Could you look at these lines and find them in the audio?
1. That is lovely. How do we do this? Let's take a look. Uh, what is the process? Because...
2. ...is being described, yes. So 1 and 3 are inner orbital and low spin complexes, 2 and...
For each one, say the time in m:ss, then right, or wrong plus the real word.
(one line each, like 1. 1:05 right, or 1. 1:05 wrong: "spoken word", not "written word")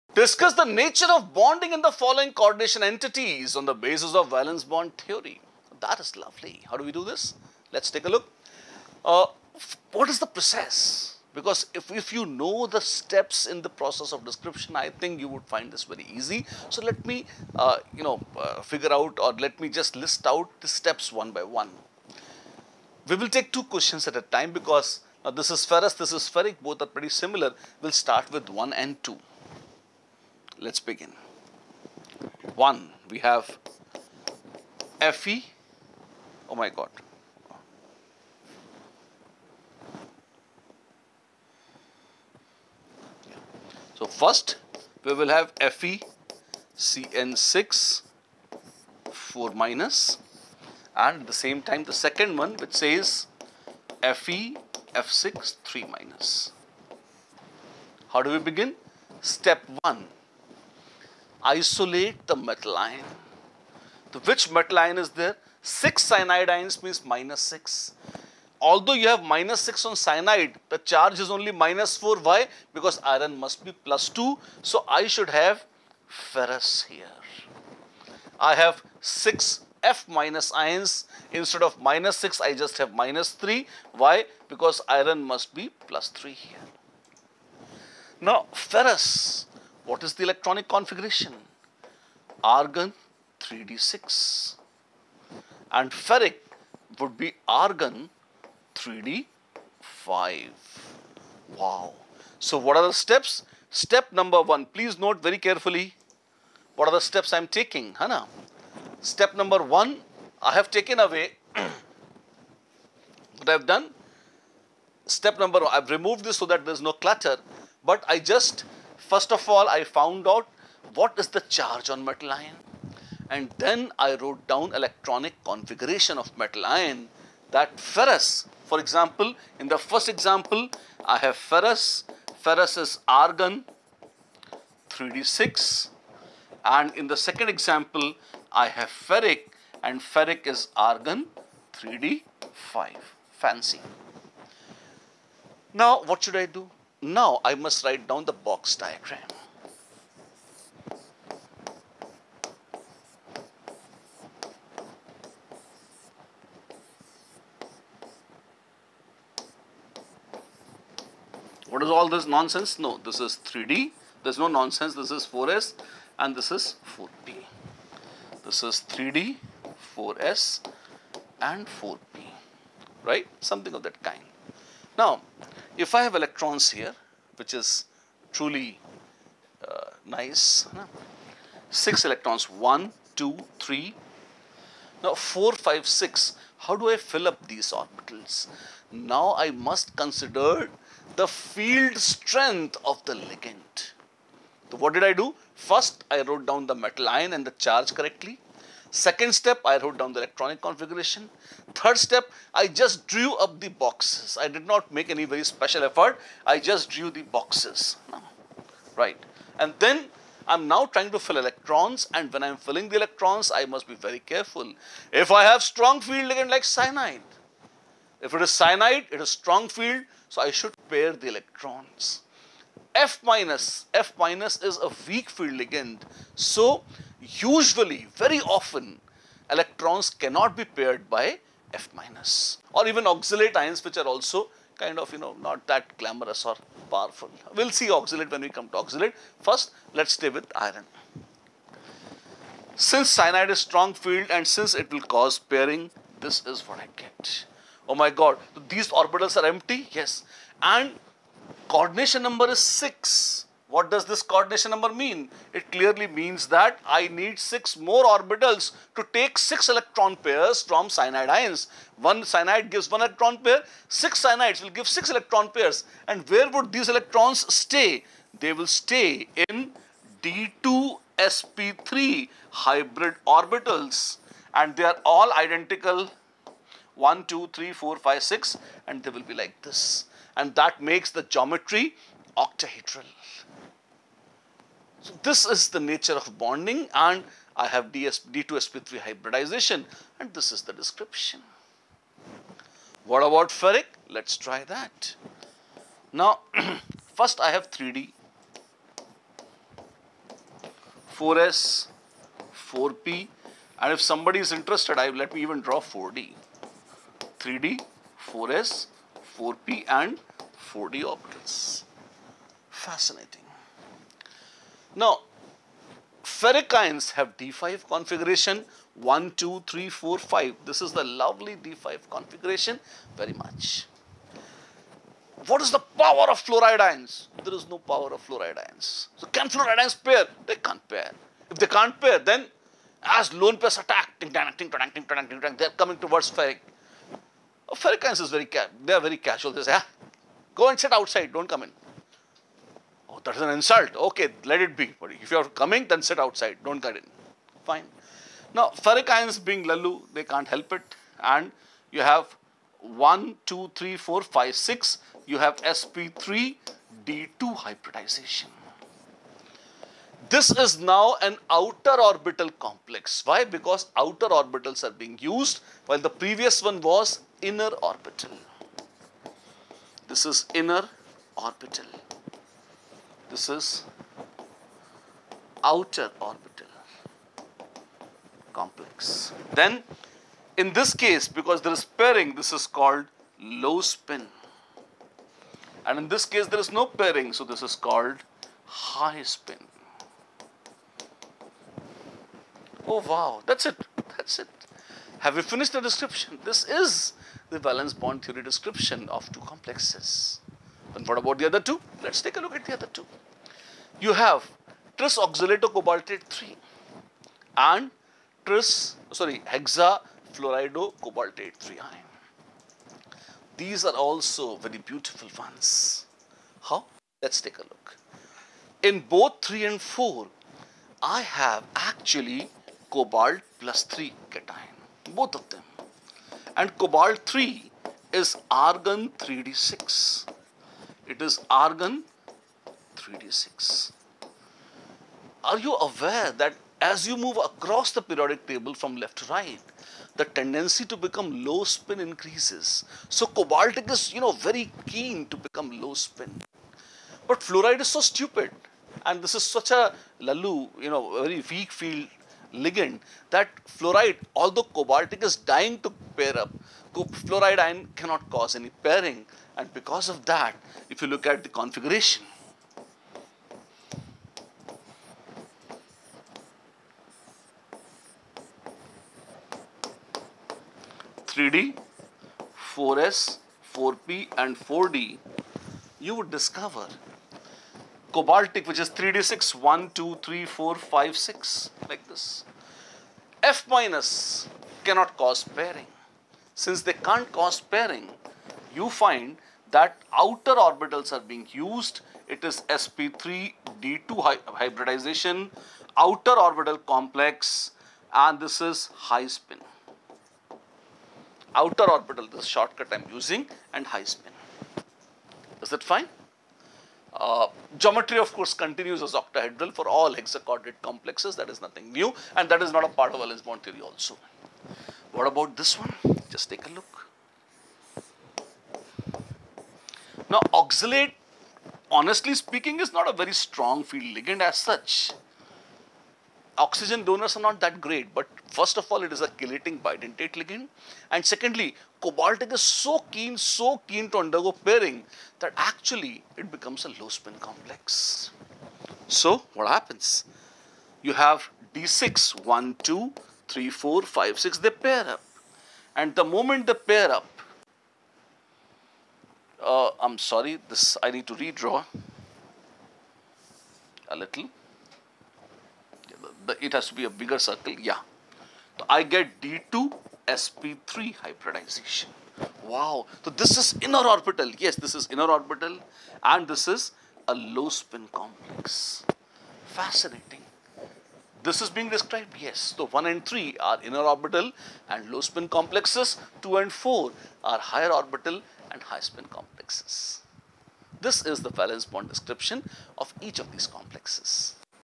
1. 0:05 right
2. 9:31 right.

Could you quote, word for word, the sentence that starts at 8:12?
It is sp3d2 hy hybridization, outer orbital complex, and this is high spin.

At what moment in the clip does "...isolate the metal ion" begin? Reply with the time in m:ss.
1:01.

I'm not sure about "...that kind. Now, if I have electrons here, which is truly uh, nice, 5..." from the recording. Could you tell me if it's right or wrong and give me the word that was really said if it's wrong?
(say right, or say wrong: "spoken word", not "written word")
wrong: "6", not "5".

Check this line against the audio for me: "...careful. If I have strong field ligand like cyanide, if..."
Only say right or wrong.
right.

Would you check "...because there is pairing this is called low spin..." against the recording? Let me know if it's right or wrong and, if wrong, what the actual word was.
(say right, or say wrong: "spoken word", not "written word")
right.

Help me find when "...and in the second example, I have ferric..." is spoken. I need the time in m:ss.
2:16.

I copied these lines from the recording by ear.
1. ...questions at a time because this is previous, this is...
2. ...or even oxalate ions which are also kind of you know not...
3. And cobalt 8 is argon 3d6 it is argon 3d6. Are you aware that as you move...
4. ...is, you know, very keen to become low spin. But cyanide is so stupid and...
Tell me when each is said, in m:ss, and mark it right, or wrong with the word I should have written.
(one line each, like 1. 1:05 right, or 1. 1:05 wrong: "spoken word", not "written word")
1. 0:23 wrong: "ferrous", not "previous"
2. 3:52 right
3. 7:06 wrong: "3", not "8"
4. 7:23 wrong: "fluoride", not "cyanide".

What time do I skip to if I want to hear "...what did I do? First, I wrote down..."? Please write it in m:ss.
3:14.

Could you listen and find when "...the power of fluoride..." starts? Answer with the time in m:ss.
5:25.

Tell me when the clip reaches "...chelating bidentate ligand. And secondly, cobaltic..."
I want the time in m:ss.
8:49.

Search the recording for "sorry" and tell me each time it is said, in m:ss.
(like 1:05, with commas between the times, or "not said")
6:49, 9:10.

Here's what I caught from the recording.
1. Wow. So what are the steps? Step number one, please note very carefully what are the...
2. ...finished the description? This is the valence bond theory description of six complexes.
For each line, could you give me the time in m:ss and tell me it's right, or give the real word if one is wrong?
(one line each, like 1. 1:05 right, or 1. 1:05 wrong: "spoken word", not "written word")
1. 1:41 right
2. 6:35 wrong: "two", not "six".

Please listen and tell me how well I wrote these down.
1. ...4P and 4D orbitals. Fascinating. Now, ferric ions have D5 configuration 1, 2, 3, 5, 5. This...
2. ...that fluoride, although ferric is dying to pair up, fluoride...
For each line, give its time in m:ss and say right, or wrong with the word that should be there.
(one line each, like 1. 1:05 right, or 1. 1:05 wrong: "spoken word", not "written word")
1. 5:09 wrong: "4", not "5"
2. 7:33 wrong: "cobaltic", not "ferric".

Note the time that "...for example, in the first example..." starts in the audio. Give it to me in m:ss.
2:08.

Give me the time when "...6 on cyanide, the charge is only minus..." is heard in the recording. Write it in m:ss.
1:09.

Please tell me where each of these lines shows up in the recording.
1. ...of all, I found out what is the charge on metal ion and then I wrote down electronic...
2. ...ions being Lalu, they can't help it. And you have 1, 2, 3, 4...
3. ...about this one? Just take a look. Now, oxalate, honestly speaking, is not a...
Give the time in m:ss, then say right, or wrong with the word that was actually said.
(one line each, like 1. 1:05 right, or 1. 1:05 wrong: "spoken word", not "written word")
1. 1:59 right
2. 5:49 right
3. 8:35 right.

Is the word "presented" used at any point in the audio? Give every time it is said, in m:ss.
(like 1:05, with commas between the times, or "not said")
not said.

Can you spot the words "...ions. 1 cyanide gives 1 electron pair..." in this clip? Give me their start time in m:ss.
4:21.